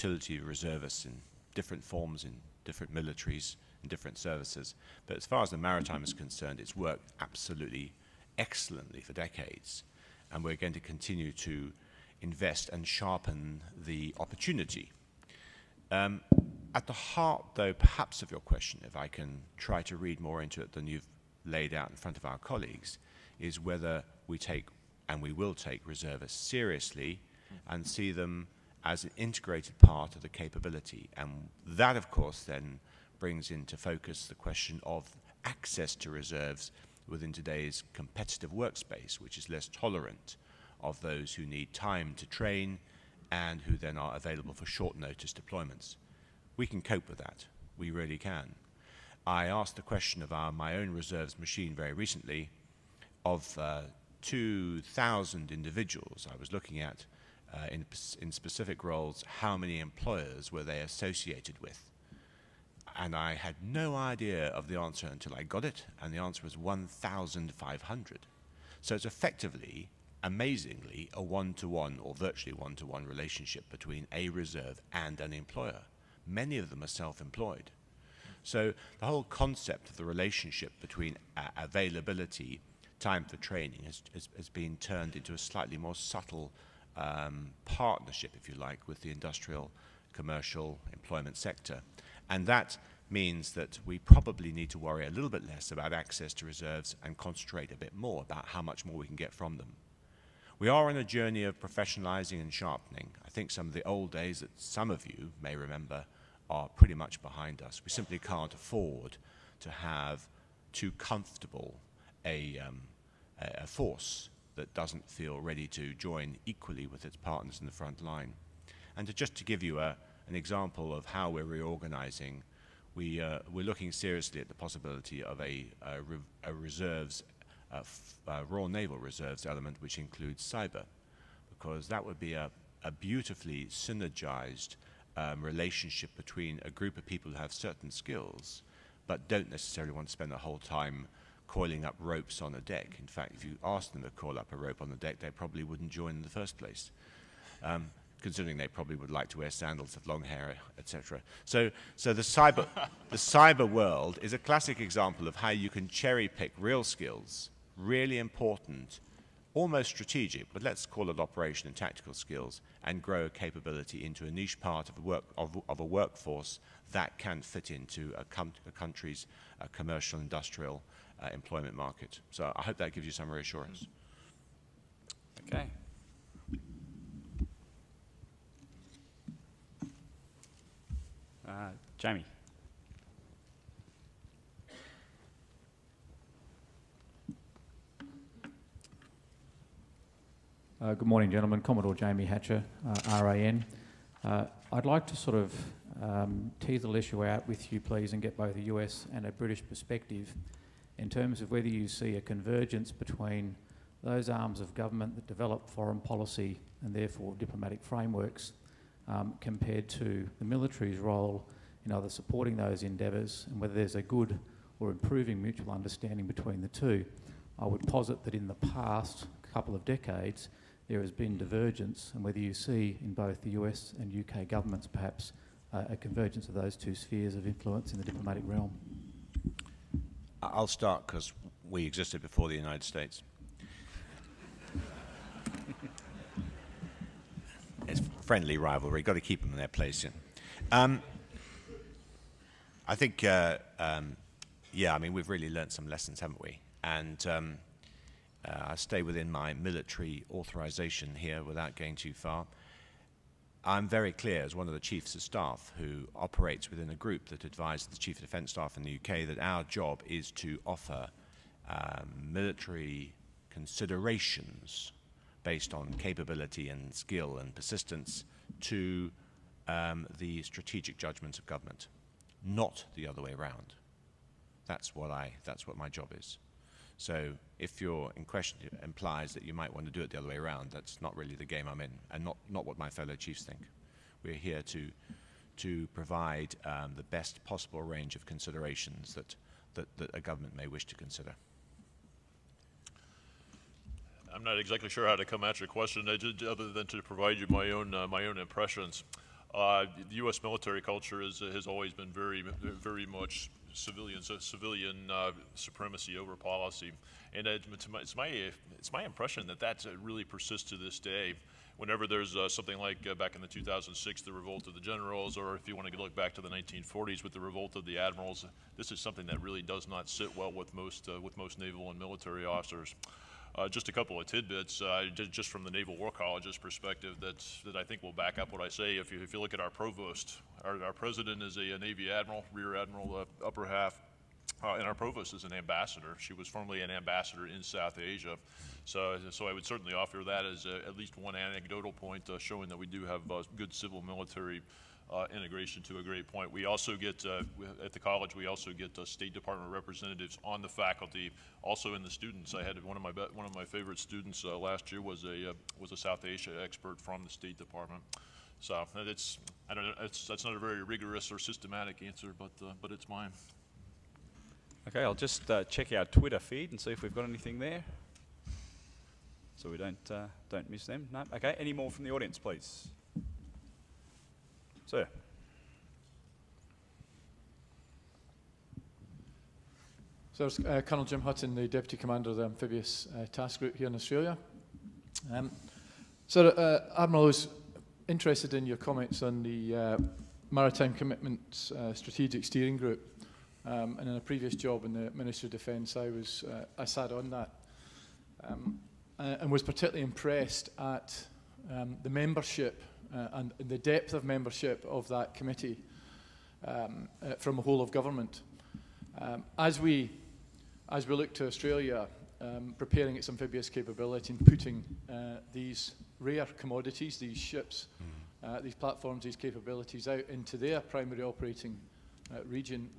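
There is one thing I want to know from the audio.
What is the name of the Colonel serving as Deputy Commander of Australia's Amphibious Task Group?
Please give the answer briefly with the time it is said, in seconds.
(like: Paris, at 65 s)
Jim Hutton, at 381 s.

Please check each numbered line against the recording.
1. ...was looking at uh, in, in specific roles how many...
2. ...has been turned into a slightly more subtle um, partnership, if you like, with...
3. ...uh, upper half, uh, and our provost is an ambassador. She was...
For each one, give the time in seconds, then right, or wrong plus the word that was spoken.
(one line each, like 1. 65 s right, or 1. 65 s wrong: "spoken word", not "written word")
1. 56 s right
2. 84 s right
3. 333 s right.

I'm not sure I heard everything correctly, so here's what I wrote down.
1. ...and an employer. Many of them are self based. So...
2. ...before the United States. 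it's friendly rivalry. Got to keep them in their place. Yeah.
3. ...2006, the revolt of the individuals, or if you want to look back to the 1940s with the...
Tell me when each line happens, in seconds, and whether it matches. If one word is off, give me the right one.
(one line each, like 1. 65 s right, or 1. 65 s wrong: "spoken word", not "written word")
1. 74 s wrong: "employed", not "based"
2. 232 s right
3. 313 s wrong: "generals", not "individuals".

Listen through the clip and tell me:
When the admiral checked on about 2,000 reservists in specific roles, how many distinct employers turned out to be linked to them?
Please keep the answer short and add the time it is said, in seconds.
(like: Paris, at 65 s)
1,500, at 66 s.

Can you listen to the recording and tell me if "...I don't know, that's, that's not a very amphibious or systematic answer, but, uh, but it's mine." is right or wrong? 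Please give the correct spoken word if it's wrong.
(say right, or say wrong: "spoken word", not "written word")
wrong: "rigorous", not "amphibious".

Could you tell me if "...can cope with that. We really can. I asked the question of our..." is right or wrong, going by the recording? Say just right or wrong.
right.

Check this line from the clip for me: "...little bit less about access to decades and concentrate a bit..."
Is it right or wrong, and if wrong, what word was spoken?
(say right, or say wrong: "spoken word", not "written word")
wrong: "reserves", not "decades".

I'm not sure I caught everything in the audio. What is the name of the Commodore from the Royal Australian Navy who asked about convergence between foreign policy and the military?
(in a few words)
Jamie Hatcher.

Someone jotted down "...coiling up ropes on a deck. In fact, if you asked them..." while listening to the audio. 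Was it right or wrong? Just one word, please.
right.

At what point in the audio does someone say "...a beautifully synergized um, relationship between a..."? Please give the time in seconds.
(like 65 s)
132 s.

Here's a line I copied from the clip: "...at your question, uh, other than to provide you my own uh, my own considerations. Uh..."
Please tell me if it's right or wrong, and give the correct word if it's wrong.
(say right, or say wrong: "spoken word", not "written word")
wrong: "impressions", not "considerations".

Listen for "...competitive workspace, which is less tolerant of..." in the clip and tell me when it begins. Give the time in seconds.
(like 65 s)
37 s.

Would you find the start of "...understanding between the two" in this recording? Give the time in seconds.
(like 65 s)
215 s.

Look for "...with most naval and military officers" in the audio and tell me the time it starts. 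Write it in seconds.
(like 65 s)
321 s.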